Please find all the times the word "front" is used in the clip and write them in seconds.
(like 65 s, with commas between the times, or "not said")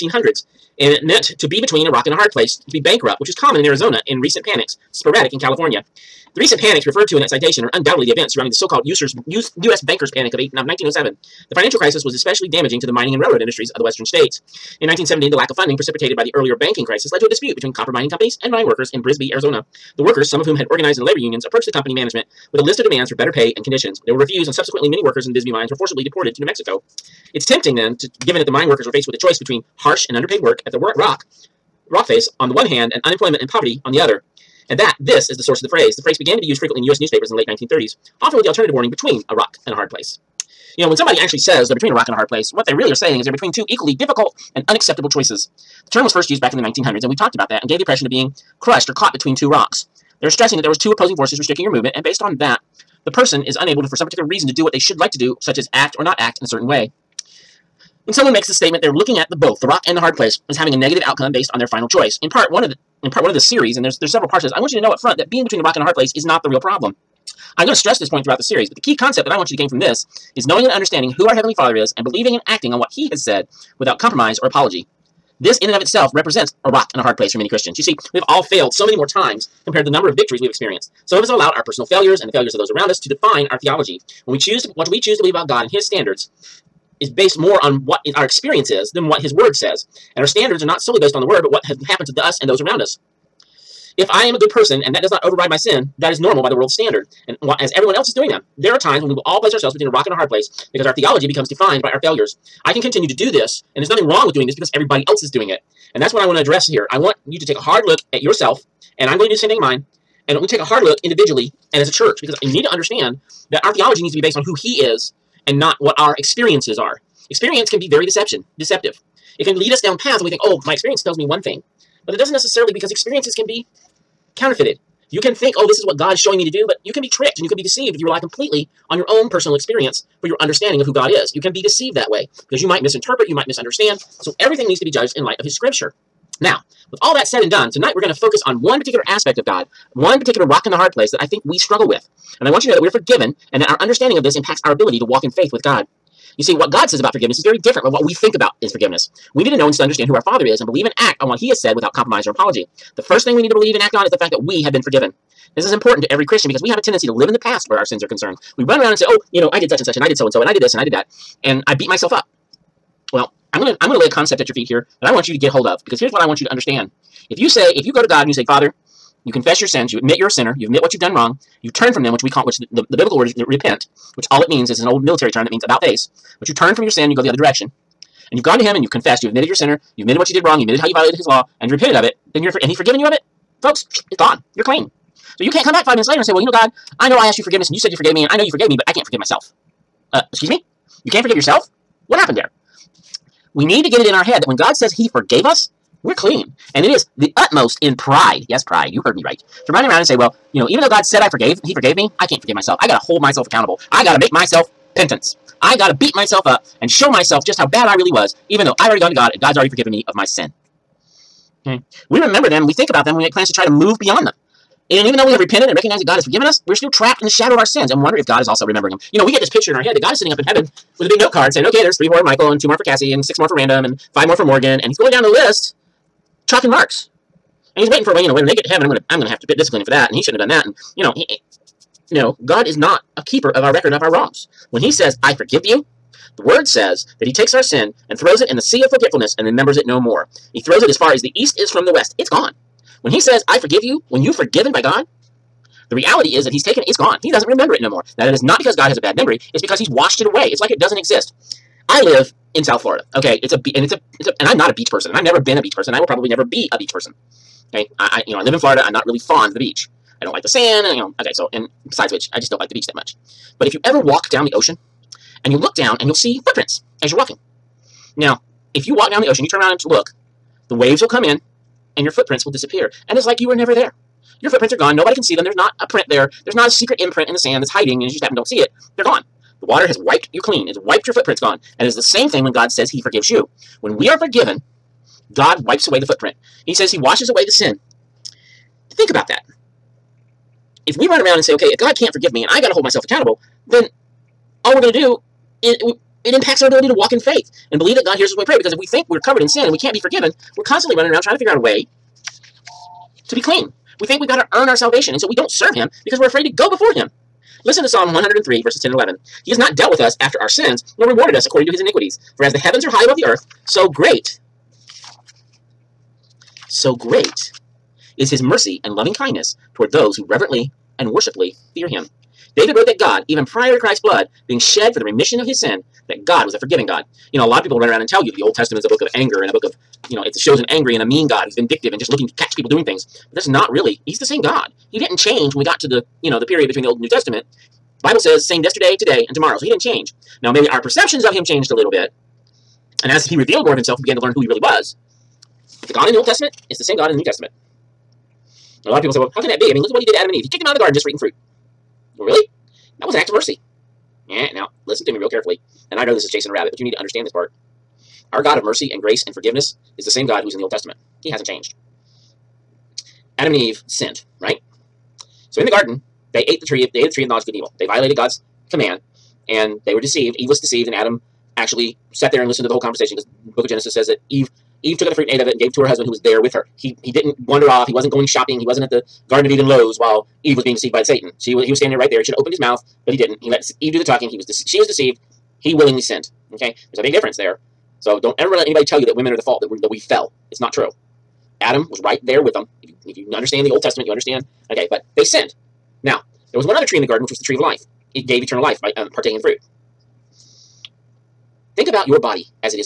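64 s.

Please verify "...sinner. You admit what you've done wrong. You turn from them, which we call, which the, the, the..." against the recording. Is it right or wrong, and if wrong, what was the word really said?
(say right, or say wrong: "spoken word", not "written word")
right.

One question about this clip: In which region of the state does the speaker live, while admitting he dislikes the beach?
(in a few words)
South Florida.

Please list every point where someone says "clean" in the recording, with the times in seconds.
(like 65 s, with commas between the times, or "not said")
184 s, 196 s, 280 s, 303 s.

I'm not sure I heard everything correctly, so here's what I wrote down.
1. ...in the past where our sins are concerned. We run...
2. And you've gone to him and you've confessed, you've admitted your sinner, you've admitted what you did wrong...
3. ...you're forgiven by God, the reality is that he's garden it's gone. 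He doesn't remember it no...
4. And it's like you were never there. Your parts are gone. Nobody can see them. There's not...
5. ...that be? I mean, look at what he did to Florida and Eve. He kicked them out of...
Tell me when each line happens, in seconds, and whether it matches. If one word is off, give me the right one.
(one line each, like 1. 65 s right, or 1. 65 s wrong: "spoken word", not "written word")
1. 157 s right
2. 178 s right
3. 244 s wrong: "taken", not "garden"
4. 273 s wrong: "footprints", not "parts"
5. 349 s wrong: "Adam", not "Florida".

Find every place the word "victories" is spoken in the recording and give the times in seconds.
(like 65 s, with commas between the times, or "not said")
80 s.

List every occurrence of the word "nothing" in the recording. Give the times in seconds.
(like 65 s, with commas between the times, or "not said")
103 s.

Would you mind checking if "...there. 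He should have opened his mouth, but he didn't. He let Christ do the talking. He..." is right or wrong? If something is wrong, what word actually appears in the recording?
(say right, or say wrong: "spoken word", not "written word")
wrong: "Eve", not "Christ".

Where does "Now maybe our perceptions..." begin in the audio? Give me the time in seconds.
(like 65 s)
340 s.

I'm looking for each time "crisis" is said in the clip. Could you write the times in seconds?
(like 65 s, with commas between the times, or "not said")
11 s, 16 s.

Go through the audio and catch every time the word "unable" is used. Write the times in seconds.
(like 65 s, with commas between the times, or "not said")
53 s.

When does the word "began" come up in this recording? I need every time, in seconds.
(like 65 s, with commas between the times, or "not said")
36 s, 344 s.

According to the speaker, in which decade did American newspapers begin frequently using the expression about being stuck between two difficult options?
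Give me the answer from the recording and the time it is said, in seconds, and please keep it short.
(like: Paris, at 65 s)
late 1930s, at 37 s.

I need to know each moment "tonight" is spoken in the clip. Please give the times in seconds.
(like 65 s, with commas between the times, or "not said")
137 s.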